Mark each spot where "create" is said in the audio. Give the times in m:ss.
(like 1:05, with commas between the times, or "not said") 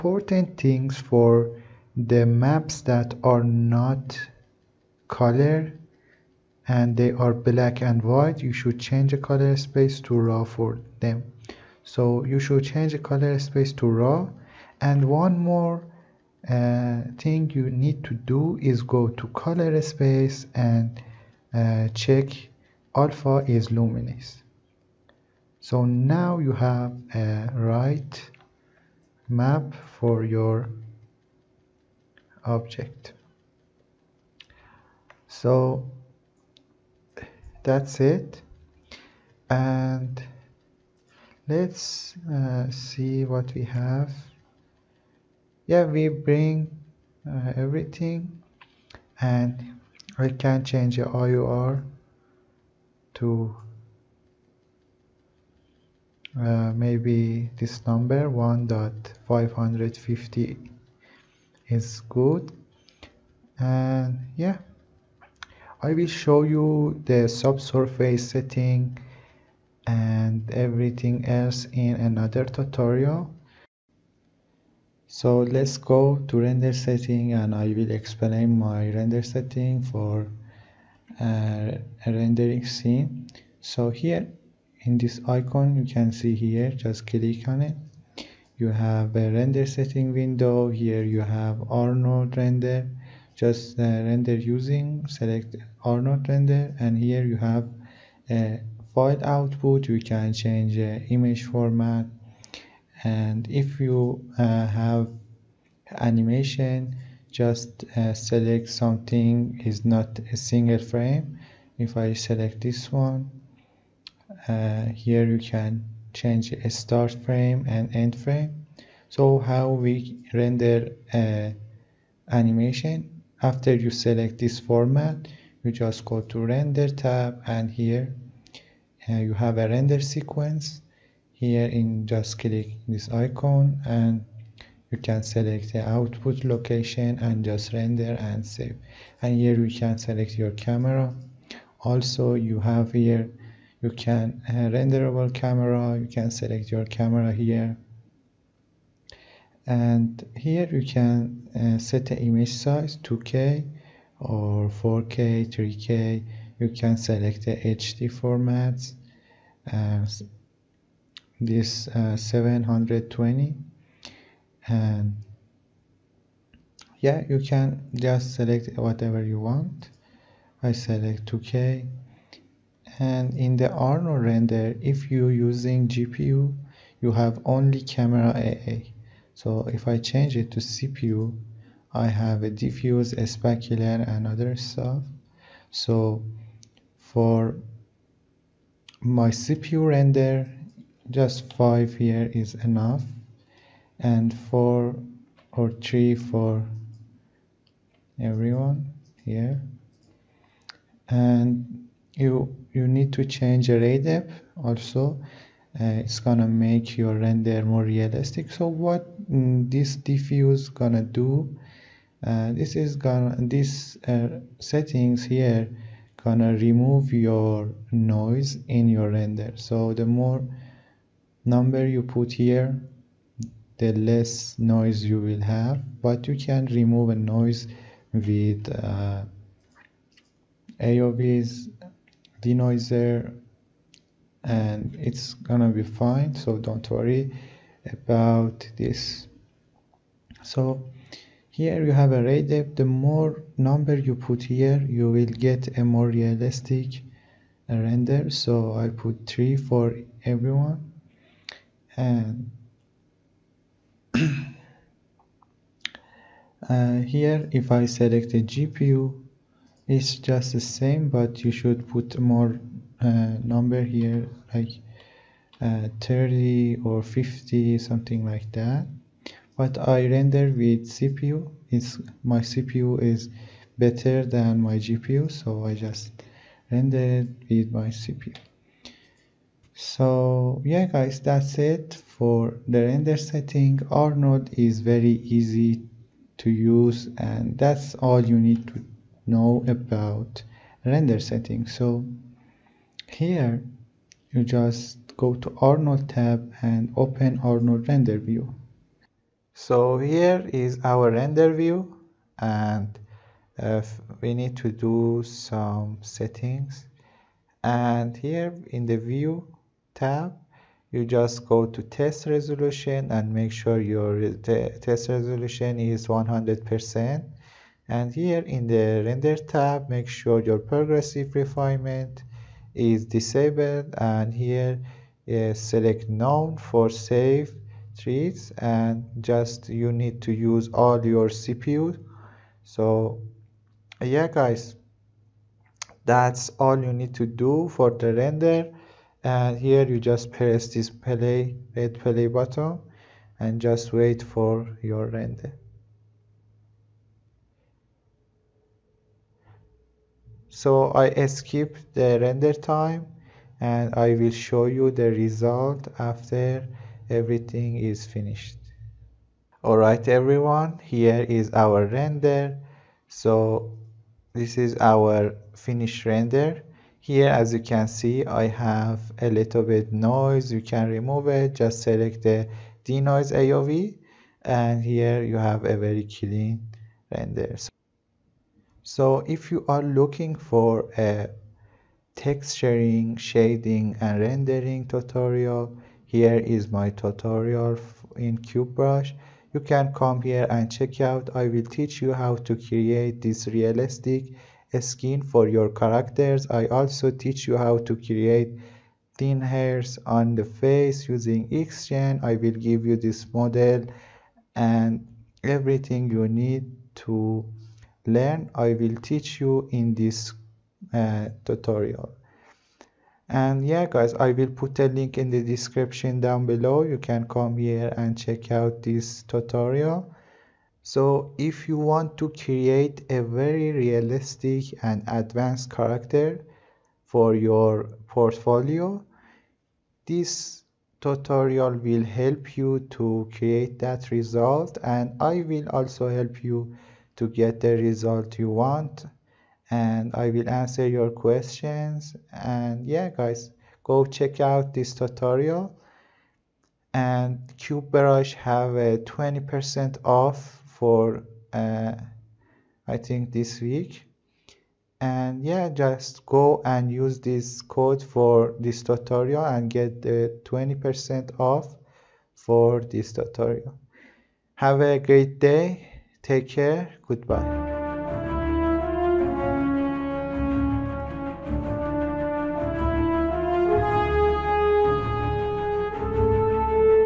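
6:32, 6:37, 7:02, 7:13.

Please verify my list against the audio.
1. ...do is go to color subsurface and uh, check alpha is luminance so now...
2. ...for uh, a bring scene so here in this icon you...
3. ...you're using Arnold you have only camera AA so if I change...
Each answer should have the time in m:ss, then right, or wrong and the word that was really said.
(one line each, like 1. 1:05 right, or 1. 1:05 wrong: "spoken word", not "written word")
1. 0:18 wrong: "space", not "subsurface"
2. 1:19 wrong: "rendering", not "bring"
3. 2:55 wrong: "GPU", not "Arnold".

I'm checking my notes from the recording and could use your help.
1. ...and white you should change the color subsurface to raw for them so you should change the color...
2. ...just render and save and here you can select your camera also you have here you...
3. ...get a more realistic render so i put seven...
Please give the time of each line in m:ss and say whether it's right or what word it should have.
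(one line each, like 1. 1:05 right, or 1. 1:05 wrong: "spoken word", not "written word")
1. 0:07 wrong: "space", not "subsurface"
2. 2:17 right
3. 4:05 wrong: "three", not "seven".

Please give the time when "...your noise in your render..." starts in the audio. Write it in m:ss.
3:37.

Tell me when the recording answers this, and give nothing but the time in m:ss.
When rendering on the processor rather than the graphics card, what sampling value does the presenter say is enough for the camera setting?
3:11.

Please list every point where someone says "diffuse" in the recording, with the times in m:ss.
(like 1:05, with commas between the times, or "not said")
3:02, 3:29.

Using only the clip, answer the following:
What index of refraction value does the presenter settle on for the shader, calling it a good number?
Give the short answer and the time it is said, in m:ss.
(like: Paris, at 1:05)
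1.550, at 0:58.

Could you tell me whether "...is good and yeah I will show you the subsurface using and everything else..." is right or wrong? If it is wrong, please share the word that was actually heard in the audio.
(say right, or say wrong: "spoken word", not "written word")
wrong: "setting", not "using".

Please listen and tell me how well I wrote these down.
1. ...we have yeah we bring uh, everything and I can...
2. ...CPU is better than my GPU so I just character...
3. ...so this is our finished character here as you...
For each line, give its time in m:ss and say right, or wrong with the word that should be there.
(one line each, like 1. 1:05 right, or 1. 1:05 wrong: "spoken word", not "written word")
1. 0:43 right
2. 4:32 wrong: "render", not "character"
3. 6:03 wrong: "render", not "character".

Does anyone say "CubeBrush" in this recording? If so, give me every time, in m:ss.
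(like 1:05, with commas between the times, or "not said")
6:28, 7:27.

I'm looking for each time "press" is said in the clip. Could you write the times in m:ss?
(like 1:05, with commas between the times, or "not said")
5:40.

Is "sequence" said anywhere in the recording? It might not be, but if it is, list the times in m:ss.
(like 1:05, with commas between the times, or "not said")
2:10.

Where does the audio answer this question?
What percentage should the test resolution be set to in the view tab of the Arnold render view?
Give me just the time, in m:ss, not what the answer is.
5:16.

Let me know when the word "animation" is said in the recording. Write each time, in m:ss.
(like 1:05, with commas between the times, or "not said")
1:45, 2:02.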